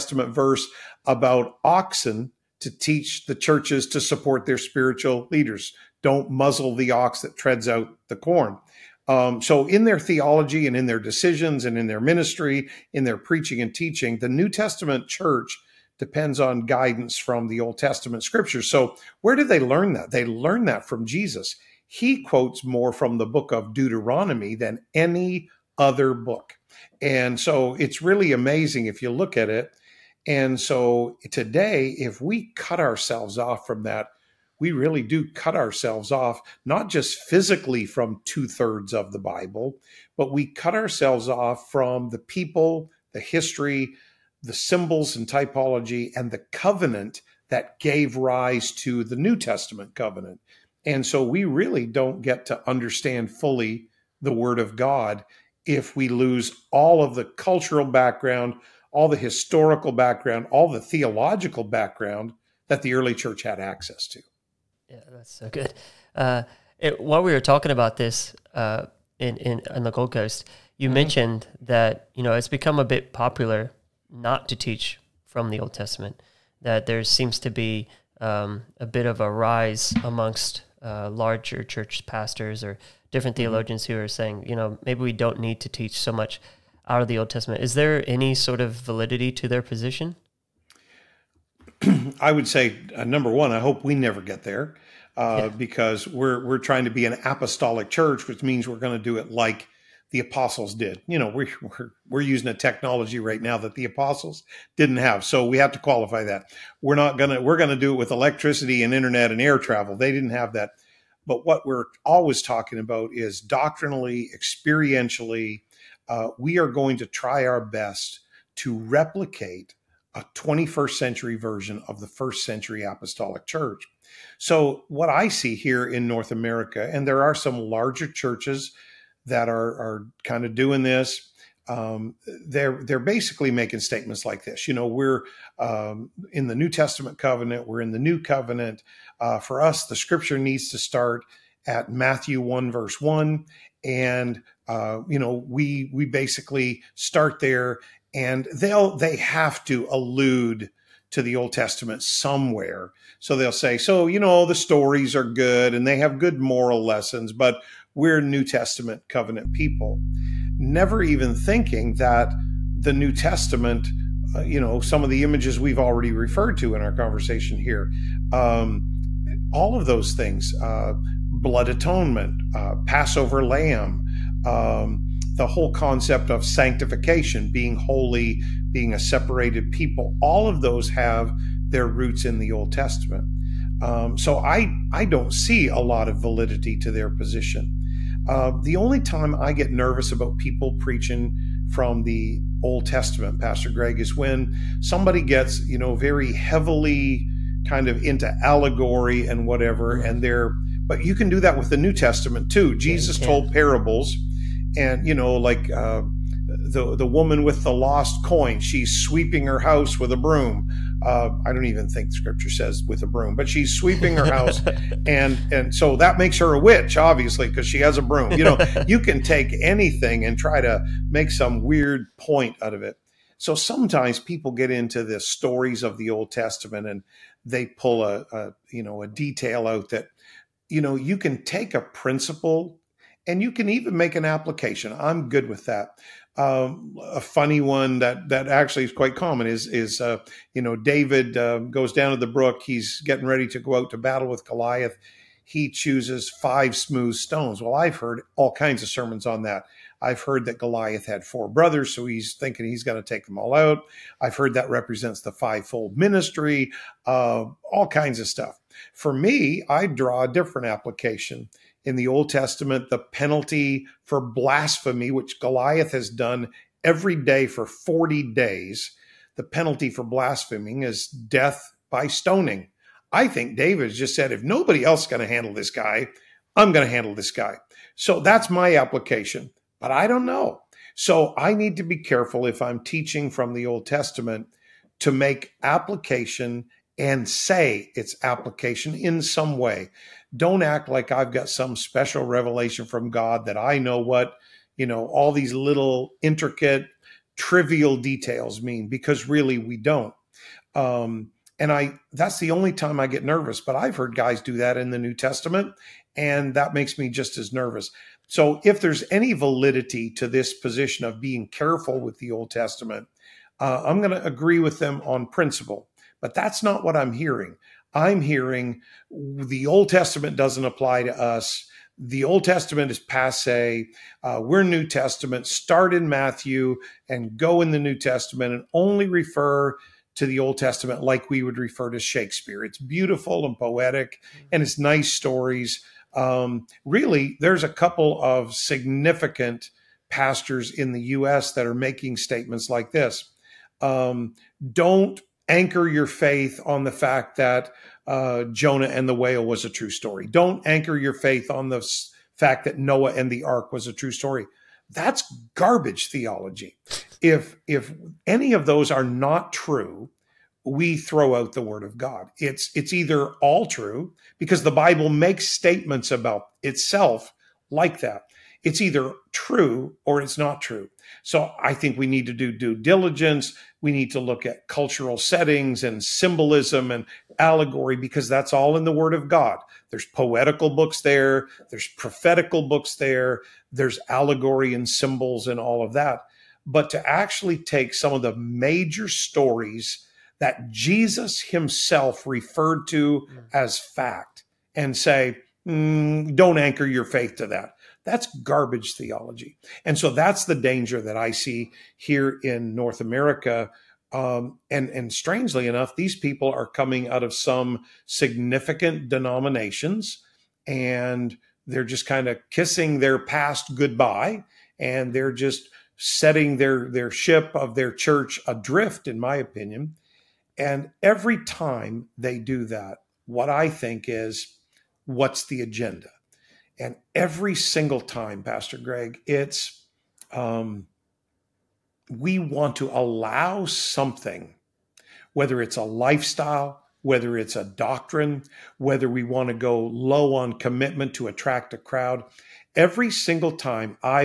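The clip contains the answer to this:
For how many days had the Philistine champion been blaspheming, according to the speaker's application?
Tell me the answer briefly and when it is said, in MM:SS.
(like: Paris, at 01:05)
40, at 04:27.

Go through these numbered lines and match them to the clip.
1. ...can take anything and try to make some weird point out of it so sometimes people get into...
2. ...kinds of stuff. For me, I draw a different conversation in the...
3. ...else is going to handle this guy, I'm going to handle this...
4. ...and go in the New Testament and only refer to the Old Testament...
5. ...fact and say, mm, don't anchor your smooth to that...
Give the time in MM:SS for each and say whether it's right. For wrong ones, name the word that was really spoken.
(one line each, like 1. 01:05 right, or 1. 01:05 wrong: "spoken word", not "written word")
1. 03:38 right
2. 04:17 wrong: "application", not "conversation"
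3. 04:34 right
4. 05:27 right
5. 06:33 wrong: "faith", not "smooth".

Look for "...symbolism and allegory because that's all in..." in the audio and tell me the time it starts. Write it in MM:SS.
06:16.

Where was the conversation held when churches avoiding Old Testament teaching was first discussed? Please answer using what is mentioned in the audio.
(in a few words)
Gold Coast.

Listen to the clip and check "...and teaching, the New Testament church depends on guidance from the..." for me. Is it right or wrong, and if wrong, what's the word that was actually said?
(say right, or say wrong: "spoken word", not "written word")
right.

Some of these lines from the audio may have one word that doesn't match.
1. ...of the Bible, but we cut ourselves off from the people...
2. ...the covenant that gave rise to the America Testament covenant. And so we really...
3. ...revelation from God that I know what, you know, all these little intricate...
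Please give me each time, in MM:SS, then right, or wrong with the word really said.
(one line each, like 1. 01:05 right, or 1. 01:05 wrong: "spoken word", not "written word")
1. 00:38 right
2. 00:46 wrong: "New", not "America"
3. 04:52 right.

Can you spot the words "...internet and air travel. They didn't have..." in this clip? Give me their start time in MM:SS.
01:48.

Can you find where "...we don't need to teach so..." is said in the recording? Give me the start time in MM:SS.
01:25.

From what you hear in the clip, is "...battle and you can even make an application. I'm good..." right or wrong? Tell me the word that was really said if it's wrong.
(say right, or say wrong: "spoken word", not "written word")
wrong: "principle", not "battle".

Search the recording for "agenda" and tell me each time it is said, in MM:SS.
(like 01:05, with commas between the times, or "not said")
07:05.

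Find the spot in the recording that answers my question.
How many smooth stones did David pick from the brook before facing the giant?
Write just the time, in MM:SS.
04:06.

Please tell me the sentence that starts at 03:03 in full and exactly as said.
Um, so I I don't see a lot of validity to their position.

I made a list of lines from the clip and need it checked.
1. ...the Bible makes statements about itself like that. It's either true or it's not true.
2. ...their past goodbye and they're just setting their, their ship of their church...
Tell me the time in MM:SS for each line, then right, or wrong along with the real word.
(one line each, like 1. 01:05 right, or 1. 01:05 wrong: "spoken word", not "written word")
1. 06:04 right
2. 06:52 right.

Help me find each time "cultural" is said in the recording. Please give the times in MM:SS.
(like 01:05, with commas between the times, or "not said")
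00:57, 06:14.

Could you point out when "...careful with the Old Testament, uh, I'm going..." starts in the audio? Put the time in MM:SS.
05:11.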